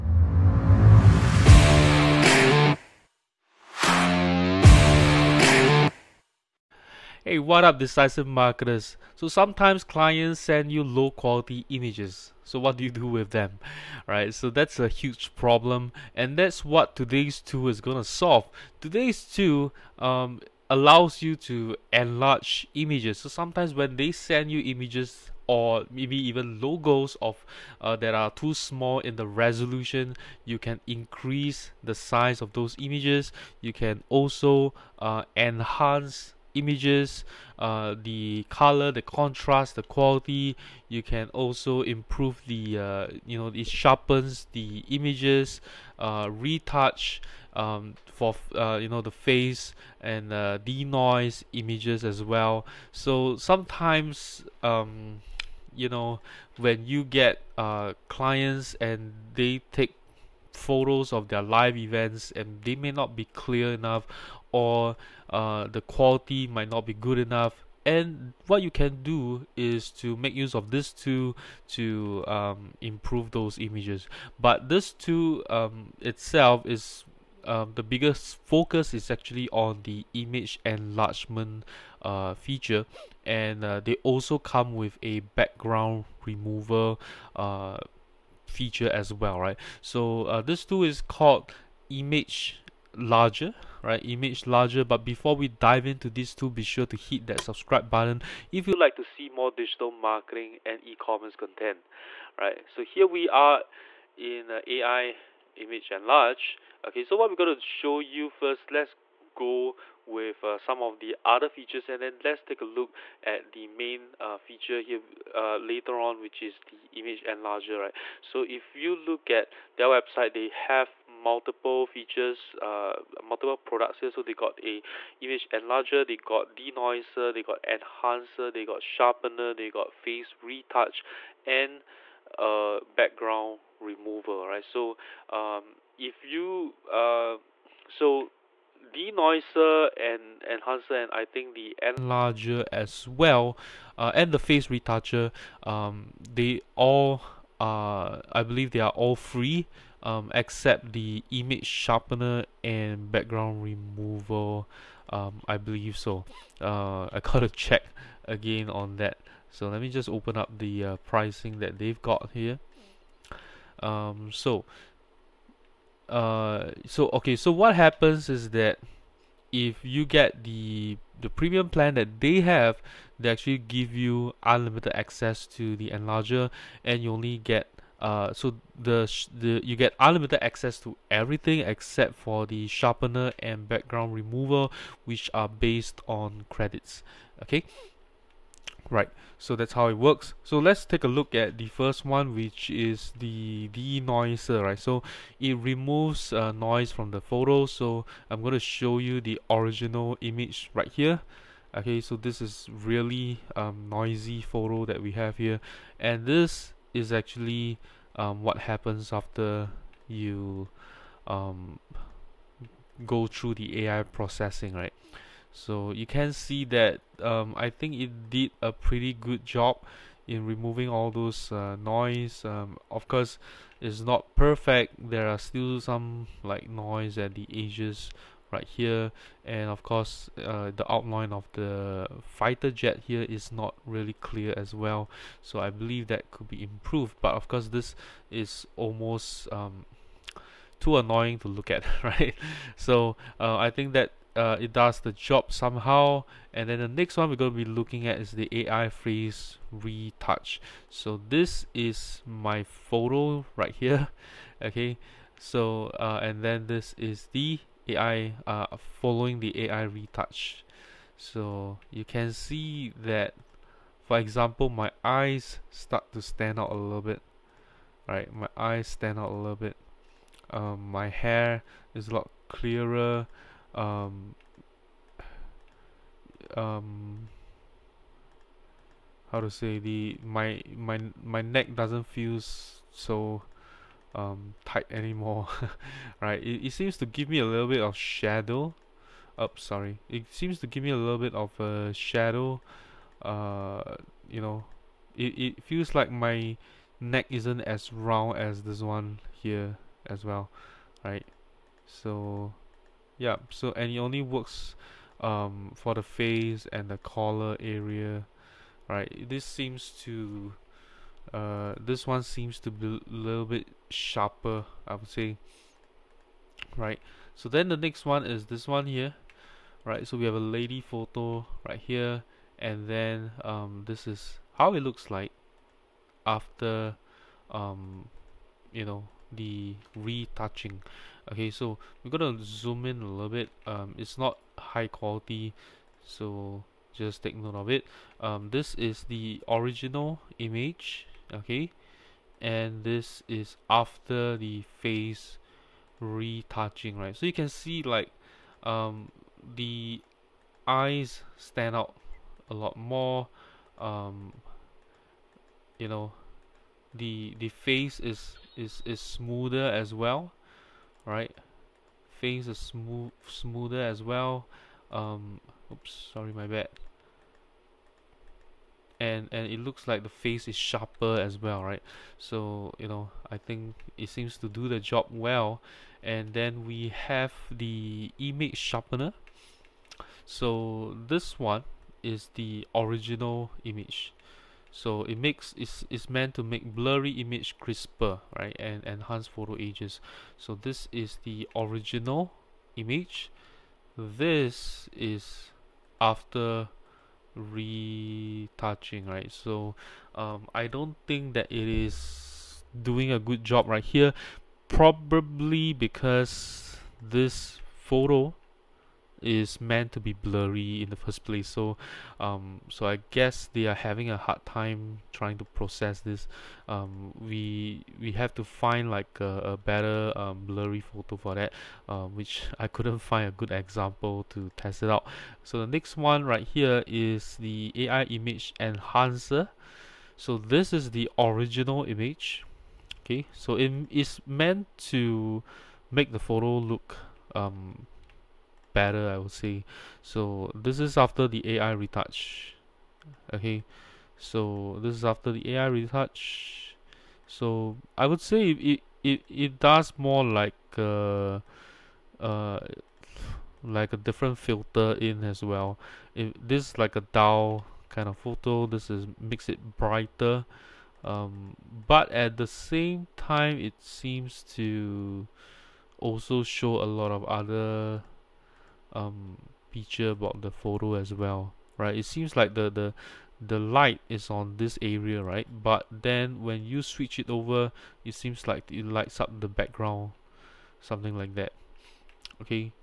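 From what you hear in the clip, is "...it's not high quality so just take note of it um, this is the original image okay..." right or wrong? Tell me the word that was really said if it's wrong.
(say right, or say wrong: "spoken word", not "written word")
right.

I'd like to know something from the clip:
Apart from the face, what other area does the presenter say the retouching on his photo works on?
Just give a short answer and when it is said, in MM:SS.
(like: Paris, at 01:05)
collar area, at 05:06.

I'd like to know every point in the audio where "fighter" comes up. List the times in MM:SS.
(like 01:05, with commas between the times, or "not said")
03:52.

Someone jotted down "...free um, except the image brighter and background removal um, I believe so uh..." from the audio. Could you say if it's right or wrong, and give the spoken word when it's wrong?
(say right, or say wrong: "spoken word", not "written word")
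wrong: "sharpener", not "brighter".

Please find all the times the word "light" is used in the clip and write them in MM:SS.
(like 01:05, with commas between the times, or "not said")
07:53, 07:58.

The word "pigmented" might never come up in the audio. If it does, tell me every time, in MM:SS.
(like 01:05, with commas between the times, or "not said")
not said.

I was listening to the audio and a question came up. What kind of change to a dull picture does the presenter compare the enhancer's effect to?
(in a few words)
a different filter.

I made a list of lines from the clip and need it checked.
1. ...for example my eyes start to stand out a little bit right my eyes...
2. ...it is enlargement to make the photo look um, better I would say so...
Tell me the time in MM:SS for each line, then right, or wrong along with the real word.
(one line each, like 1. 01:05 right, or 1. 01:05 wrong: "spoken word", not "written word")
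1. 04:24 right
2. 07:13 wrong: "meant", not "enlargement".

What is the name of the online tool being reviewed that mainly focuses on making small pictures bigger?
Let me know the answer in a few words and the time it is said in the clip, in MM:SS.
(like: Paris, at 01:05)
ImgLarger, at 01:34.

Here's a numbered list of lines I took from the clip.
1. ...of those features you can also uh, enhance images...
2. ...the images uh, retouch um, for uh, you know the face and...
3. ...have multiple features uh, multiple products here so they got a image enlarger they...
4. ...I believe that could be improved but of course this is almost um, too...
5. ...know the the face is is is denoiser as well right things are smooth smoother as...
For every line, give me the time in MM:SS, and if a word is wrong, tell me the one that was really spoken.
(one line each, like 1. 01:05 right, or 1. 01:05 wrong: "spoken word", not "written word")
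1. 00:32 wrong: "images", not "features"
2. 00:44 right
3. 02:00 right
4. 03:55 right
5. 05:55 wrong: "smoother", not "denoiser".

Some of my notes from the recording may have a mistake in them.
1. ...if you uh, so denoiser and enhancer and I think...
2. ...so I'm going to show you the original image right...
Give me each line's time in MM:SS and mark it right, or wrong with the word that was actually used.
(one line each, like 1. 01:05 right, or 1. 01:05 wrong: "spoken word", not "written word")
1. 02:15 right
2. 03:17 right.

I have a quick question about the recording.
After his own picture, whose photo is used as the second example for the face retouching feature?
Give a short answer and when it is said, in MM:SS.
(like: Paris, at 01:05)
a lady, at 05:20.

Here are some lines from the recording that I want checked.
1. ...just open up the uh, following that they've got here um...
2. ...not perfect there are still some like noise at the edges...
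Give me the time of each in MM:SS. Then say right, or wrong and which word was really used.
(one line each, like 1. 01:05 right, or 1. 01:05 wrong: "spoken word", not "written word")
1. 02:39 wrong: "pricing", not "following"
2. 03:43 right.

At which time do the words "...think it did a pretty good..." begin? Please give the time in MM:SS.
03:37.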